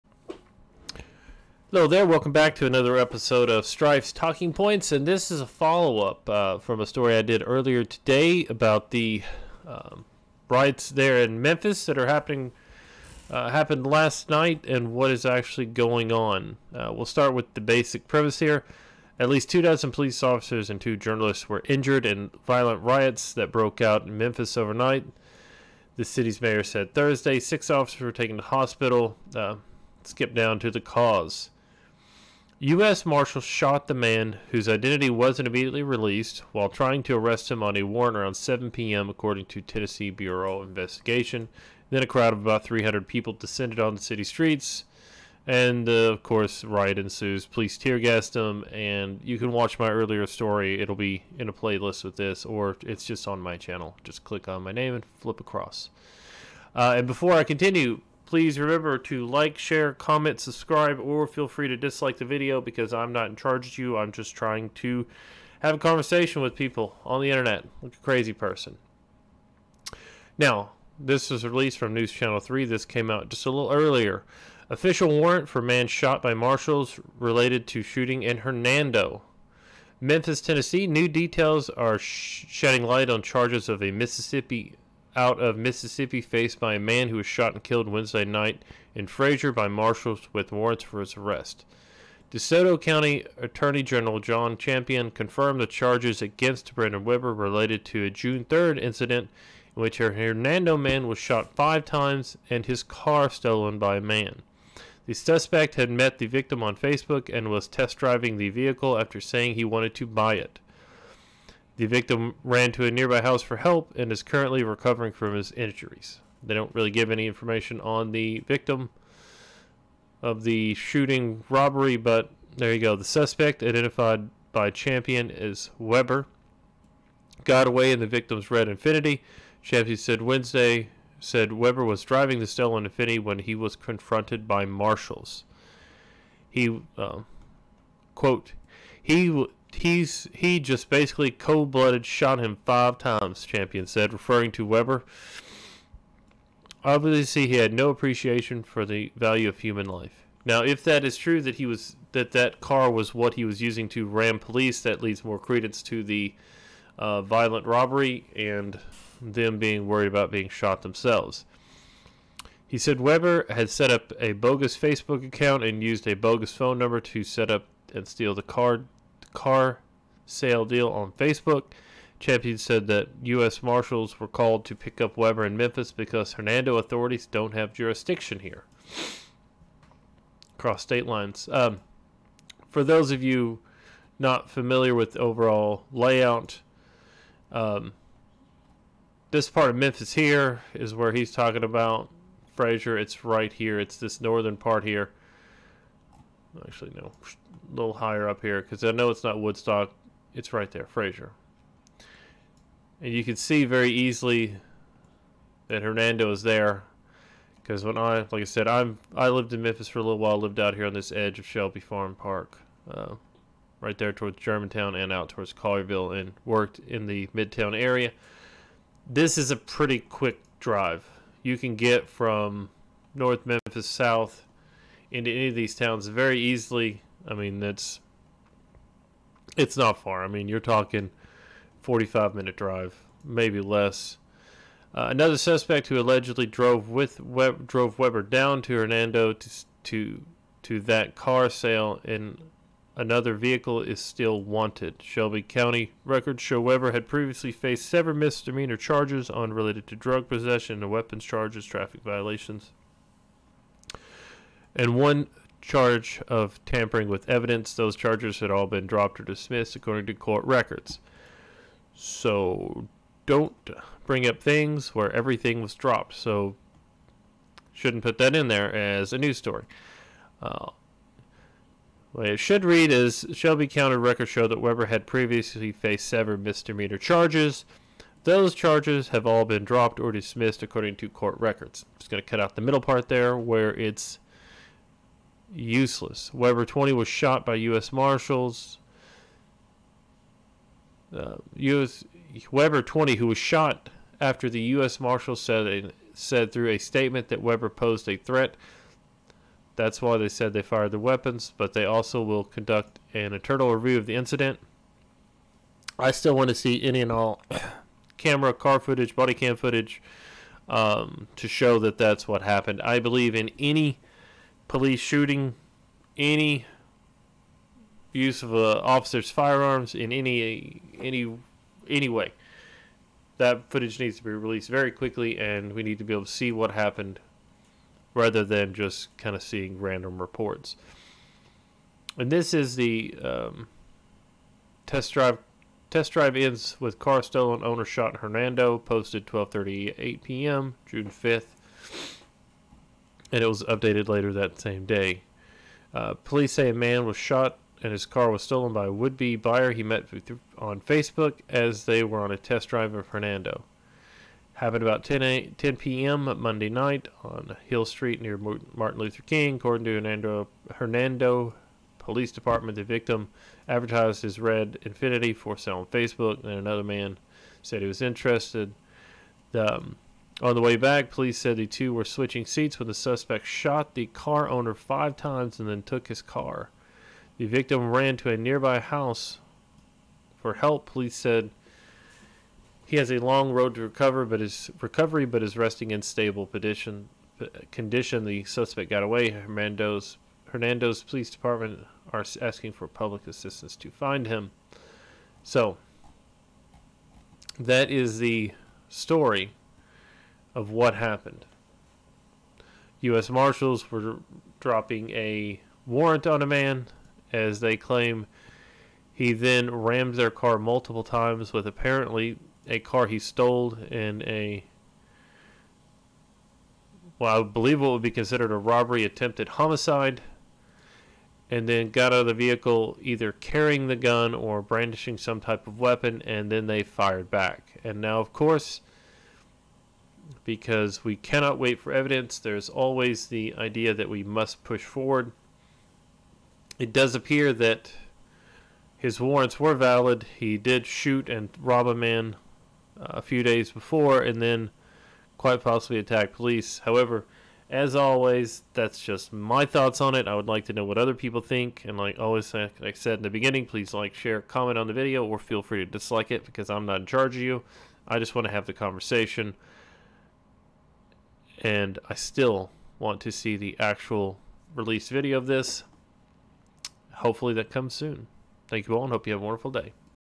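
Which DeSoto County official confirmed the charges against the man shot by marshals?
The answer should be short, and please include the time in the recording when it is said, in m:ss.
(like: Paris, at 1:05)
John Champion, at 1:34.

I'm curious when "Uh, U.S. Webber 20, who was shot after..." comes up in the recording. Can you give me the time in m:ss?
4:51.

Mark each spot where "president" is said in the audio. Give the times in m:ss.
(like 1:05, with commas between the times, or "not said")
not said.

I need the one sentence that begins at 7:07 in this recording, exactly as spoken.
And now, of course, because we cannot wait for evidence.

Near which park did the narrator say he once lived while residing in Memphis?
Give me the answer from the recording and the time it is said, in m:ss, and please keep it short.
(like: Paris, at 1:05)
Shelby Farm Park, at 3:31.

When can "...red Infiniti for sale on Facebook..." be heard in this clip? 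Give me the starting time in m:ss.
6:04.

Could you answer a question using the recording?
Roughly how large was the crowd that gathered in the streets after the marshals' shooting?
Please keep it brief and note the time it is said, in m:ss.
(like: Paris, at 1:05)
300 people, at 0:42.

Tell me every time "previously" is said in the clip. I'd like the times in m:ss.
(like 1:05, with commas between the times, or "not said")
4:07, 4:35.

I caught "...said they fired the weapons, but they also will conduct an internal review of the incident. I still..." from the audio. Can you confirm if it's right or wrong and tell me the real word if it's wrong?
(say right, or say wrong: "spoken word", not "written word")
right.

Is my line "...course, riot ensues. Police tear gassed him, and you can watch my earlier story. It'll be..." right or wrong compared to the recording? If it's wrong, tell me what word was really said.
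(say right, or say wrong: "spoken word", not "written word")
right.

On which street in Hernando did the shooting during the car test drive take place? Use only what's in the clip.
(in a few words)
Hill Street.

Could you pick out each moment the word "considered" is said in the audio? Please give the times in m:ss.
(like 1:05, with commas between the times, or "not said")
6:58.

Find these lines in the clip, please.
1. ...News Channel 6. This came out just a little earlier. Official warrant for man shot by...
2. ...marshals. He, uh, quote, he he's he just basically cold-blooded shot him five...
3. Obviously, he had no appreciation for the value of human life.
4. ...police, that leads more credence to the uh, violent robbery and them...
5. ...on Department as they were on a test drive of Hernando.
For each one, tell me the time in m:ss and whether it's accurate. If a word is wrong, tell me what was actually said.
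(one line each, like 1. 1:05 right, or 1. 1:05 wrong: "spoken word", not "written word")
1. 1:11 wrong: "3", not "6"
2. 2:14 right
3. 2:26 right
4. 2:34 right
5. 5:50 wrong: "Facebook", not "Department".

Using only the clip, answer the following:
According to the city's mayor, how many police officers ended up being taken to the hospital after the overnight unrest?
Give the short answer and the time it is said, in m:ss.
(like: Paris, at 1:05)
6, at 0:27.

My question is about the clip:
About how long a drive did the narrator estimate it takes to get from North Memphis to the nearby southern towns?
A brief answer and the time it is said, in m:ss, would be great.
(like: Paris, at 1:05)
45 minutes, at 3:51.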